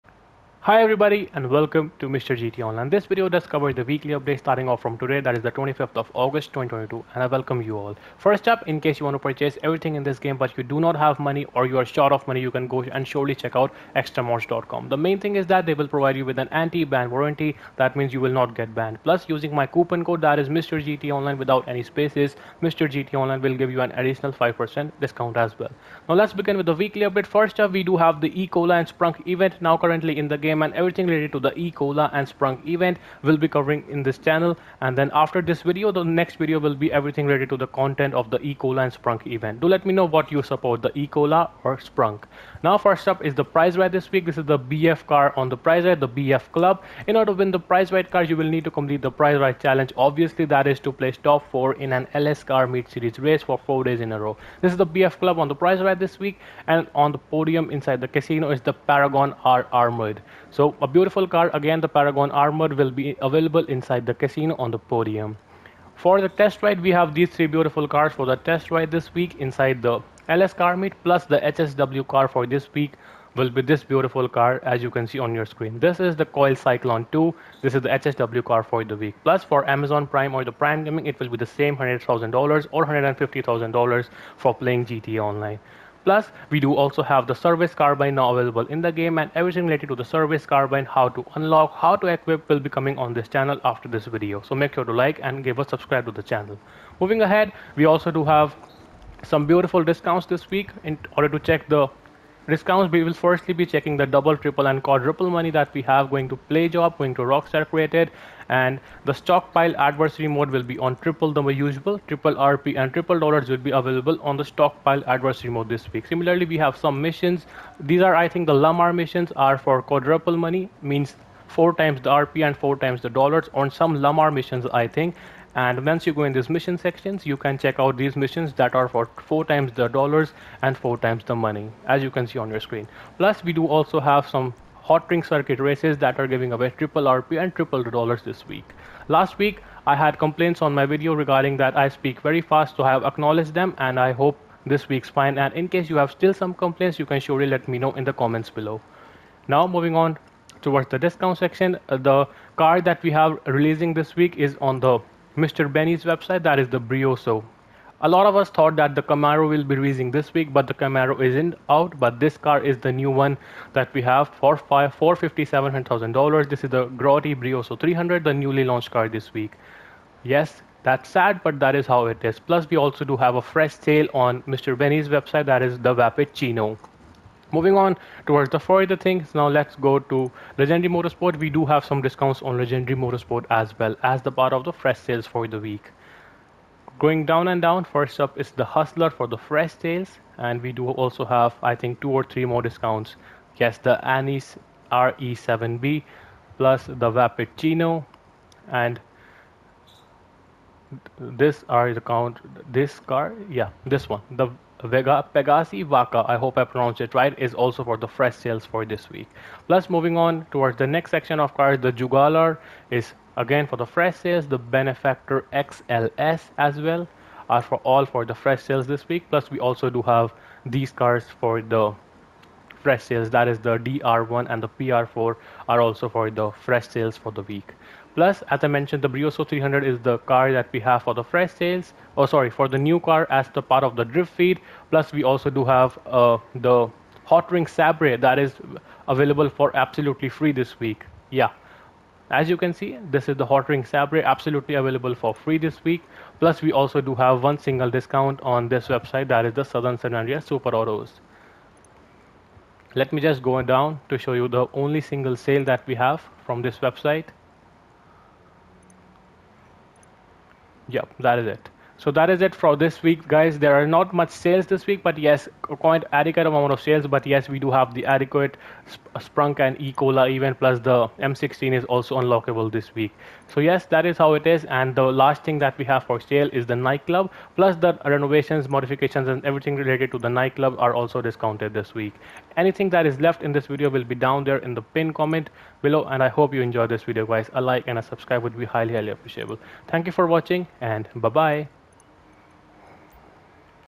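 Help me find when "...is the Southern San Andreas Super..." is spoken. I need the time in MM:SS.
04:09.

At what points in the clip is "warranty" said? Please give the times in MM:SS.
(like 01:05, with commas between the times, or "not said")
00:17.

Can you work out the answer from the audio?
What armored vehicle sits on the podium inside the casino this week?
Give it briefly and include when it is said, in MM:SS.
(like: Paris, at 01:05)
Paragon R Armored, at 00:58.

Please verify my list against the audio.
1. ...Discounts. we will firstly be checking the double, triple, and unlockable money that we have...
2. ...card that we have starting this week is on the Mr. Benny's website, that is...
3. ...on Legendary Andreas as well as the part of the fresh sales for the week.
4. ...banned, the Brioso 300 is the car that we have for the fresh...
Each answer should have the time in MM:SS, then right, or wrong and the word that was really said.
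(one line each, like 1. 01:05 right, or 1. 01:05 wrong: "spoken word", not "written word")
1. 01:42 wrong: "quadruple", not "unlockable"
2. 02:32 wrong: "releasing", not "starting"
3. 03:02 wrong: "Motorsport", not "Andreas"
4. 03:48 wrong: "mentioned", not "banned".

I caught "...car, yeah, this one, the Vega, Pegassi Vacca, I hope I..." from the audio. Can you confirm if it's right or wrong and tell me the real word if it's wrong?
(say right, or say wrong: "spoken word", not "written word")
right.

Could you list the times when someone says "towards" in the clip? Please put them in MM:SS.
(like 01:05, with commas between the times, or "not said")
02:30, 02:58, 03:30.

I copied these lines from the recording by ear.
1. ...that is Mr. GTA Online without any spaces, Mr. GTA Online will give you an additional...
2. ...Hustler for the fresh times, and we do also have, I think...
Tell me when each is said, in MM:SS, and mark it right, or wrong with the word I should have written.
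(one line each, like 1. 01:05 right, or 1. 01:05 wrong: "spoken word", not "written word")
1. 00:20 right
2. 03:08 wrong: "sales", not "times".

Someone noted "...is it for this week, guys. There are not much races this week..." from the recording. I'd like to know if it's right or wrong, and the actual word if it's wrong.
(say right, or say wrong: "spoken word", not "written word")
wrong: "sales", not "races".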